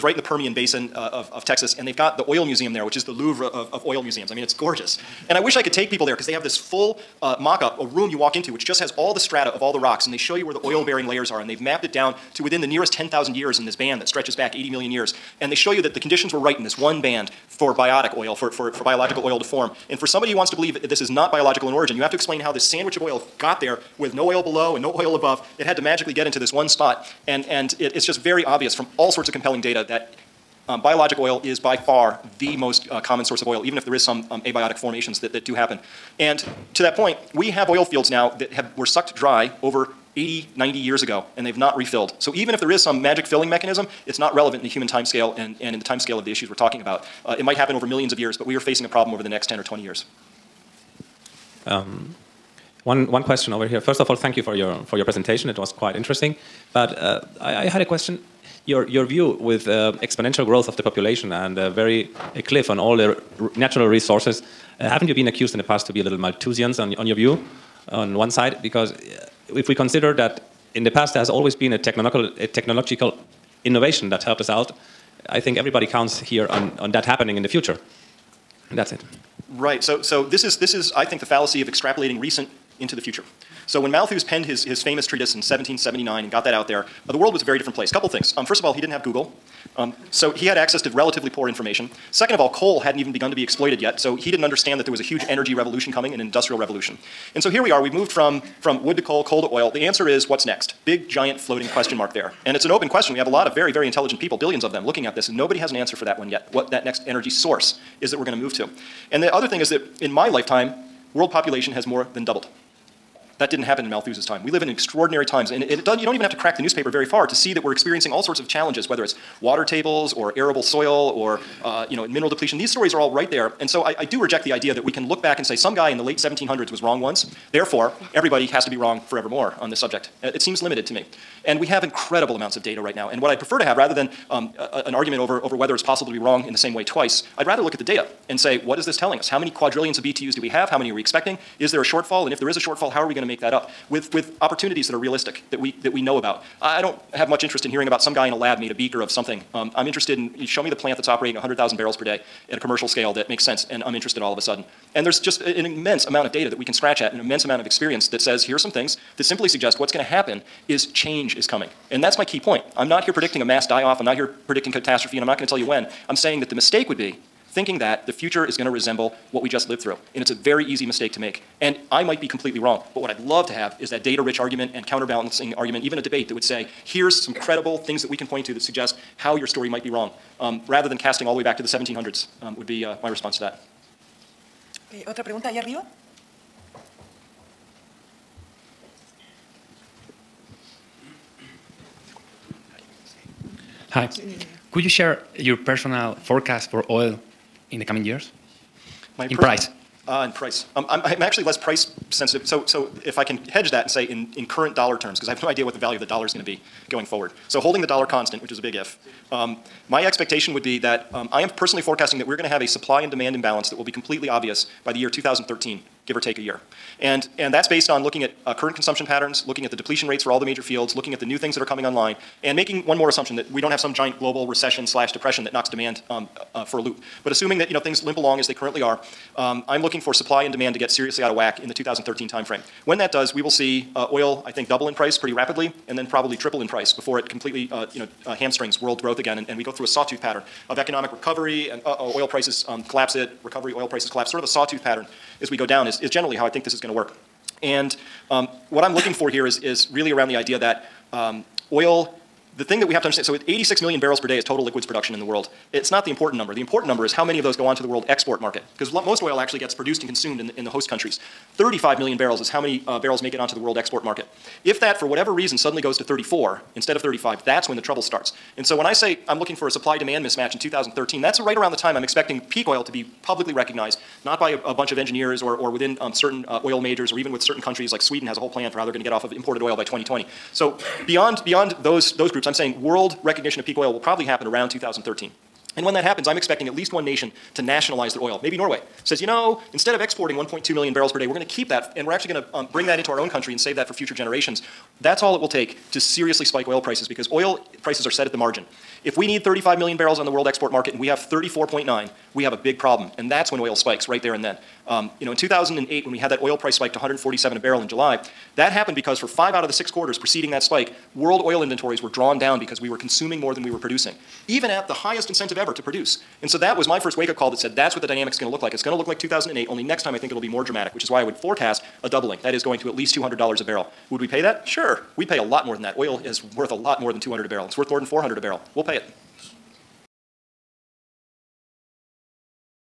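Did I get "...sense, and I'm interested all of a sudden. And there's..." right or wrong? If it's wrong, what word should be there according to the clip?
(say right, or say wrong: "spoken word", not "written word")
right.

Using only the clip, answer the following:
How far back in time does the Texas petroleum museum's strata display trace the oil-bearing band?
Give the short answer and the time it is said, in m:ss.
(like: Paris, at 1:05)
80 million years, at 0:14.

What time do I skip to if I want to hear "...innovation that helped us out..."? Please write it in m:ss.
1:13.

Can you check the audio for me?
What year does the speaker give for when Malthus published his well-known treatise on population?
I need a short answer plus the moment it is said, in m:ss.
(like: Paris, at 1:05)
1779, at 1:25.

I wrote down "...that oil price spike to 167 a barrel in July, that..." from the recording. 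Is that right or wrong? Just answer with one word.
wrong.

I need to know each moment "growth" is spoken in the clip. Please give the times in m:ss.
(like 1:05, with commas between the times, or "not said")
1:00, 3:59.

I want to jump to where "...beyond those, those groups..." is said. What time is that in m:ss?
4:41.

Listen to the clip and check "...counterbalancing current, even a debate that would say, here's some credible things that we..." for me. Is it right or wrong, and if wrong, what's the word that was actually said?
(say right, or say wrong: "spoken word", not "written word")
wrong: "argument", not "current".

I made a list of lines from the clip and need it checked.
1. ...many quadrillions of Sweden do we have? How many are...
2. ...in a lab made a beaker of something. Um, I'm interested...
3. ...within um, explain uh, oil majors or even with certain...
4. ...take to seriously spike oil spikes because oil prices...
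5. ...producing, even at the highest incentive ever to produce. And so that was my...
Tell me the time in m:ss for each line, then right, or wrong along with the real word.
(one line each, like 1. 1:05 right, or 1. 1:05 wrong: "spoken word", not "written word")
1. 2:19 wrong: "BTUs", not "Sweden"
2. 2:28 right
3. 4:35 wrong: "certain", not "explain"
4. 4:55 wrong: "prices", not "spikes"
5. 5:13 right.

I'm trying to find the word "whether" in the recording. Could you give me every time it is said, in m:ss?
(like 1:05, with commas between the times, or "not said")
1:58, 2:15.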